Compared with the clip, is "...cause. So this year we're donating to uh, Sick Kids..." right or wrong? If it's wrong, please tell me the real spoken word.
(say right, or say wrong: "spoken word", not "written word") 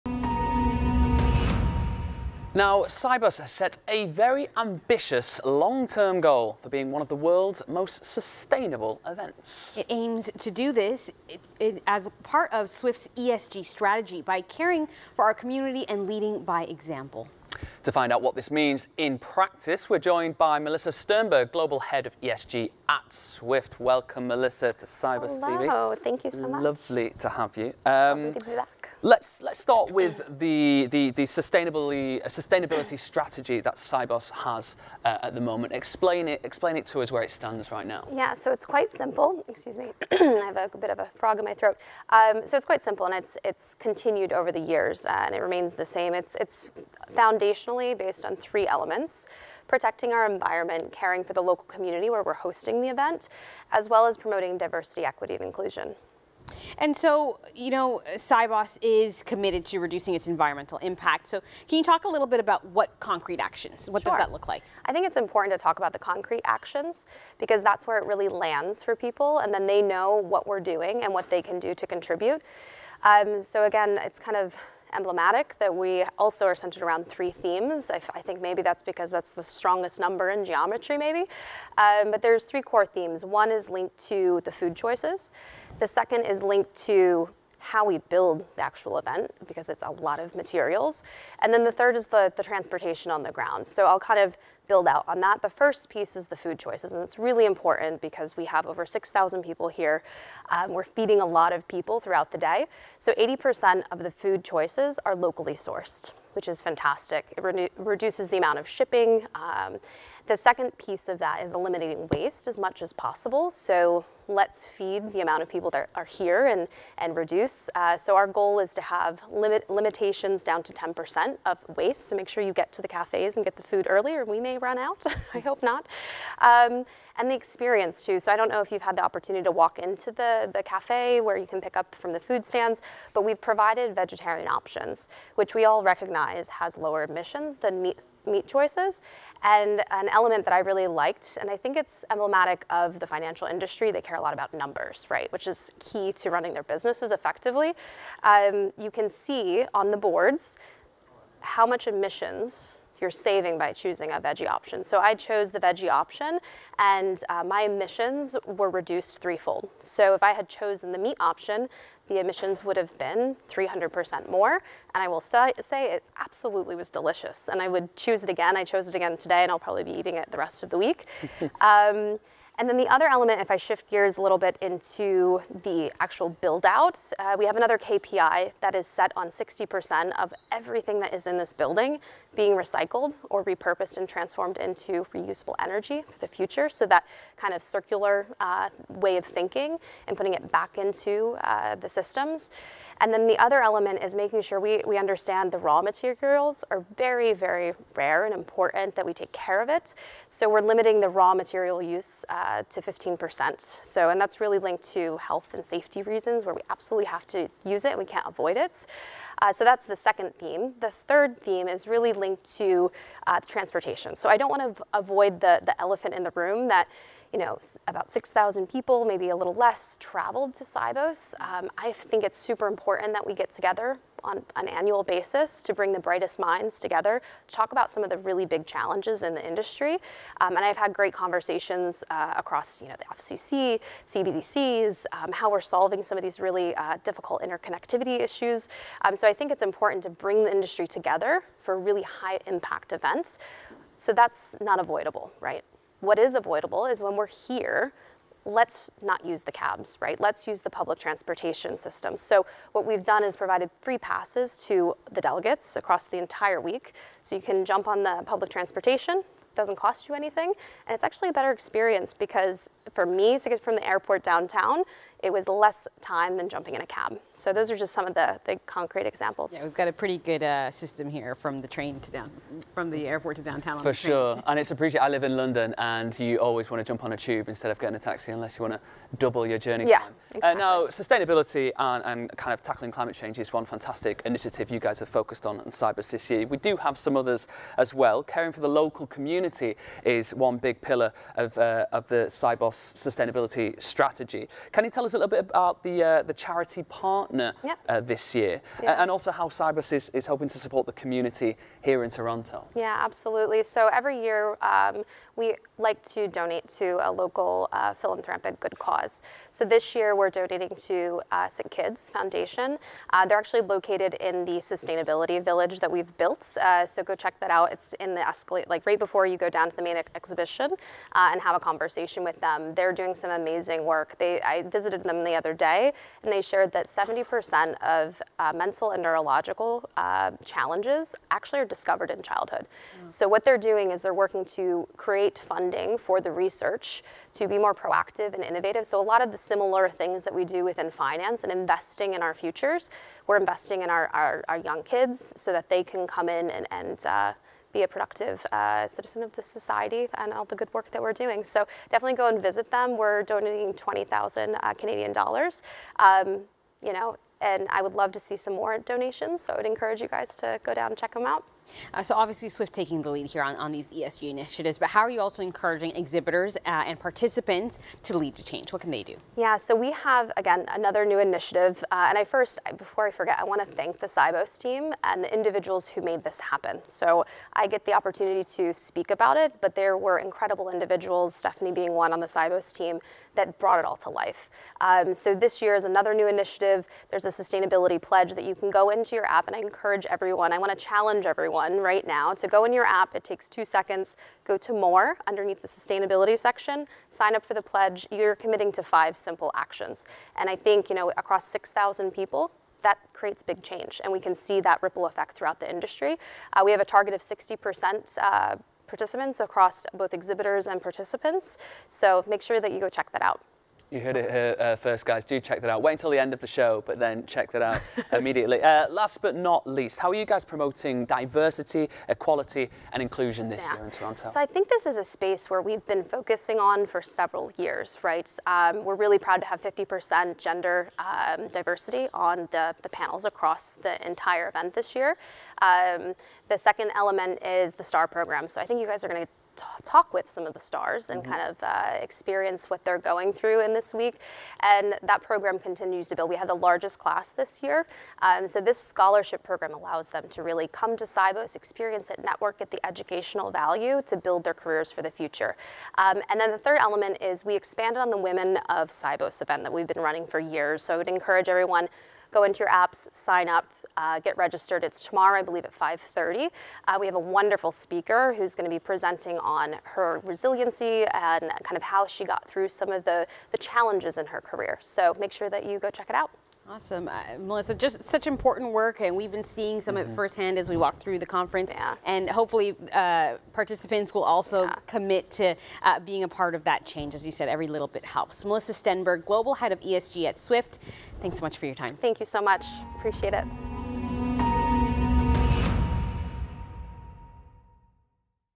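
right.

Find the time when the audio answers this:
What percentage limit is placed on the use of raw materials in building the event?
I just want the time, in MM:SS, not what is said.
03:22.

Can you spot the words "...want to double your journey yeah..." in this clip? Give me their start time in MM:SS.
04:38.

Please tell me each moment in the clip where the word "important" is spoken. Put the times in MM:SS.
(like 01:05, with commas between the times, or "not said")
01:05, 01:37, 03:18, 03:42, 03:59, 07:58.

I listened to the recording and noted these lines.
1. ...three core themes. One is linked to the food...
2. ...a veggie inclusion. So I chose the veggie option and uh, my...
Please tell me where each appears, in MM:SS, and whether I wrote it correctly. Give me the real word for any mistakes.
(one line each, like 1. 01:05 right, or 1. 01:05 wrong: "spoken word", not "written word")
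1. 01:22 right
2. 02:34 wrong: "option", not "inclusion".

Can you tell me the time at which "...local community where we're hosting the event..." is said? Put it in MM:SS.
00:51.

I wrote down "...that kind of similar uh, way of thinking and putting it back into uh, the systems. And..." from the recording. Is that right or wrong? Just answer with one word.
wrong.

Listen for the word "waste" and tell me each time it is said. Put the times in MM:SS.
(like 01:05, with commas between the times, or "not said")
01:52, 02:01.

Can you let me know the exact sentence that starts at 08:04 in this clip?
commit to uh, being a part of that change.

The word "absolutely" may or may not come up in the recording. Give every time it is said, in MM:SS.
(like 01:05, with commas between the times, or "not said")
02:46, 03:26, 05:02.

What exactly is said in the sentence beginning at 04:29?
Yeah, we've got a pretty good uh, system here from the train to down, from the airport to downtown.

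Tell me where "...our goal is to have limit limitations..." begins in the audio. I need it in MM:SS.
01:58.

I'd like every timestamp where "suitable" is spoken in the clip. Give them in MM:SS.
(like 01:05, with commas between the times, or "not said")
not said.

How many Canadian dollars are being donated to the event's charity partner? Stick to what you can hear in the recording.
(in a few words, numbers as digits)
20,000.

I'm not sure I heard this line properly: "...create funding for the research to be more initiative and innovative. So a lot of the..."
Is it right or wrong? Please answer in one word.
wrong.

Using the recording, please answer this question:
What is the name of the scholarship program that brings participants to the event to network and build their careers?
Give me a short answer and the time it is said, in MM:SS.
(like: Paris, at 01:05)
STAR program, at 07:17.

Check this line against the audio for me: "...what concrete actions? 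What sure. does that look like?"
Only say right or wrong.
right.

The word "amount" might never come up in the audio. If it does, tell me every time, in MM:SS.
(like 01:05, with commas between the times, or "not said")
01:48, 01:55.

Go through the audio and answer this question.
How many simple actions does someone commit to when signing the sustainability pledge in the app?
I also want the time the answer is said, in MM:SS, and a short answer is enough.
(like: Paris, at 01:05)
5, at 06:38.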